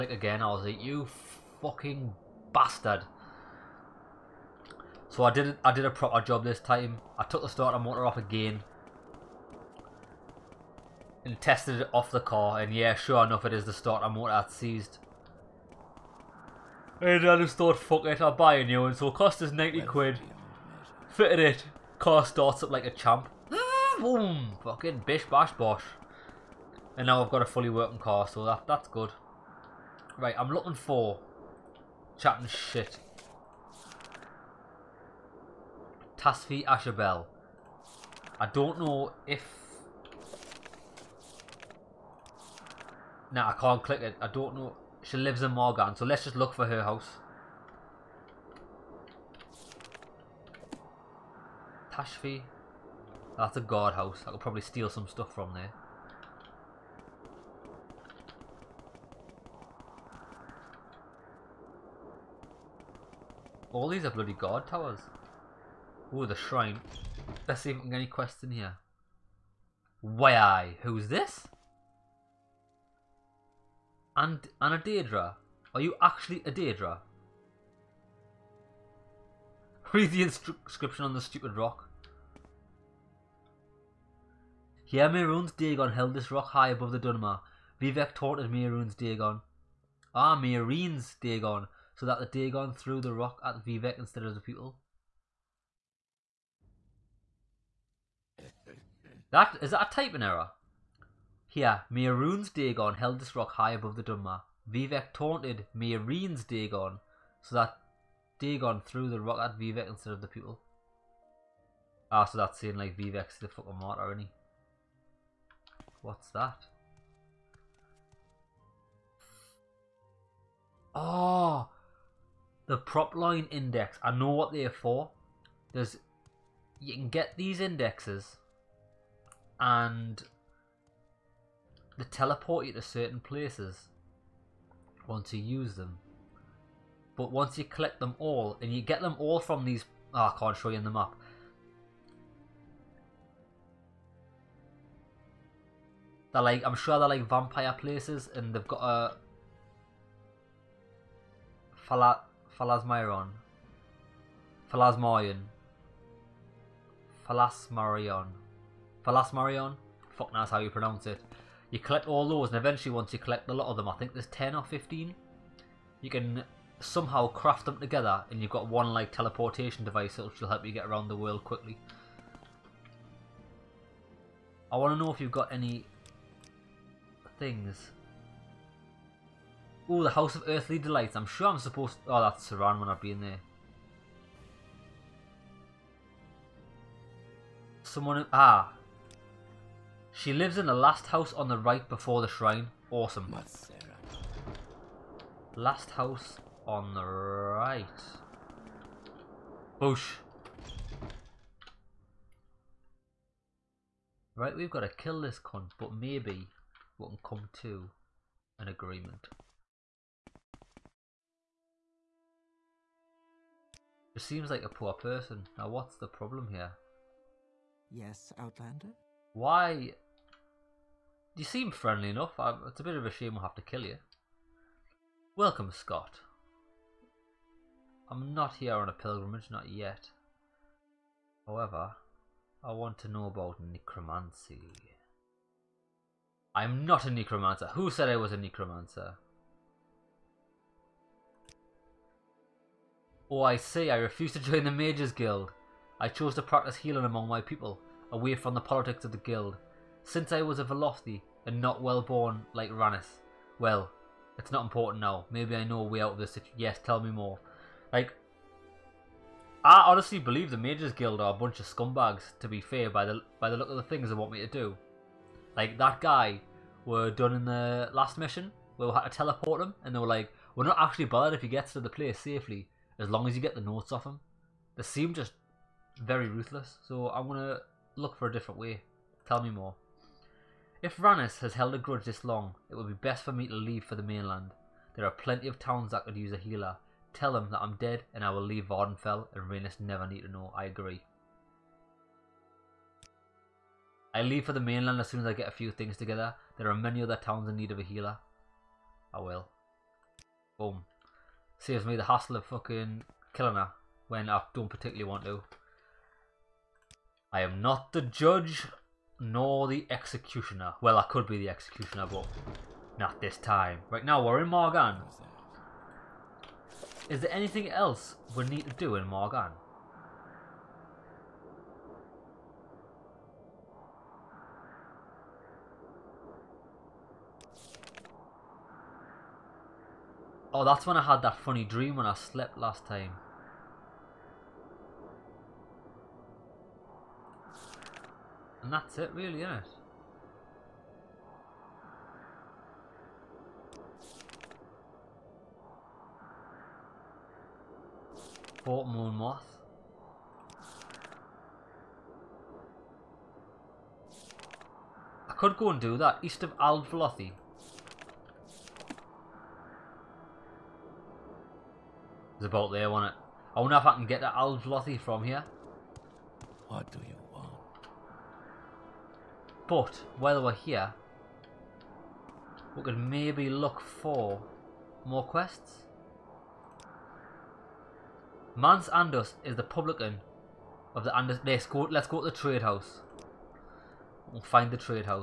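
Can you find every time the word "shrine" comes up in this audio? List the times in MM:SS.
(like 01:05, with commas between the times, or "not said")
01:06, 03:12.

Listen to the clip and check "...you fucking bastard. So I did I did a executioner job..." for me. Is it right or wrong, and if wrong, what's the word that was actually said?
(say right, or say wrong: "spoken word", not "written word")
wrong: "proper", not "executioner".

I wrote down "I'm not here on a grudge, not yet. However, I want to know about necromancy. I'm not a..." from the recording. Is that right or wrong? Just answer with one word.
wrong.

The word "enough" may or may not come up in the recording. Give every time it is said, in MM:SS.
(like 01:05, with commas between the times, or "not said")
00:13, 03:42.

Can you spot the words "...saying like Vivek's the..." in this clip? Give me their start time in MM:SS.
01:52.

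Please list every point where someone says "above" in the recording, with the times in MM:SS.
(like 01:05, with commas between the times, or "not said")
01:26, 01:43.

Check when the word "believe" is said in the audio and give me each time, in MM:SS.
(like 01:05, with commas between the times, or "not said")
04:20.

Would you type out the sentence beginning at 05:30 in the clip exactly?
Oh, that's when I had that funny dream when I slept last time.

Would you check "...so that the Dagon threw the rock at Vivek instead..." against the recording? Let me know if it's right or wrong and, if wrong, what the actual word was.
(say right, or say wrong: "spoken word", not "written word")
right.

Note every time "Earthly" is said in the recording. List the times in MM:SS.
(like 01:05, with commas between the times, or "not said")
03:00.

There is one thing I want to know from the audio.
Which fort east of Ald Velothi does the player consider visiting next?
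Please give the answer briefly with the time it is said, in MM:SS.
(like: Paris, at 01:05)
Fort Moon Moth, at 05:48.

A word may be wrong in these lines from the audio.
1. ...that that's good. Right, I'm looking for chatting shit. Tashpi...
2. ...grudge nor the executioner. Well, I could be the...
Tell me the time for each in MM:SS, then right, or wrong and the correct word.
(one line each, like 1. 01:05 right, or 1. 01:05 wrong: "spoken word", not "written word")
1. 00:28 right
2. 05:08 wrong: "judge", not "grudge".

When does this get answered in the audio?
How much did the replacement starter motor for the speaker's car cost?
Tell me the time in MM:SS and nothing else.
00:19.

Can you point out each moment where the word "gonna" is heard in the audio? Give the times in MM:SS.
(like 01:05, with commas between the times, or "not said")
not said.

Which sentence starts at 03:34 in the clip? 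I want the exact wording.
Just seems like a poor person.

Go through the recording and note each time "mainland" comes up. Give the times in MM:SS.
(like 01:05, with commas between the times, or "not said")
04:44, 04:54.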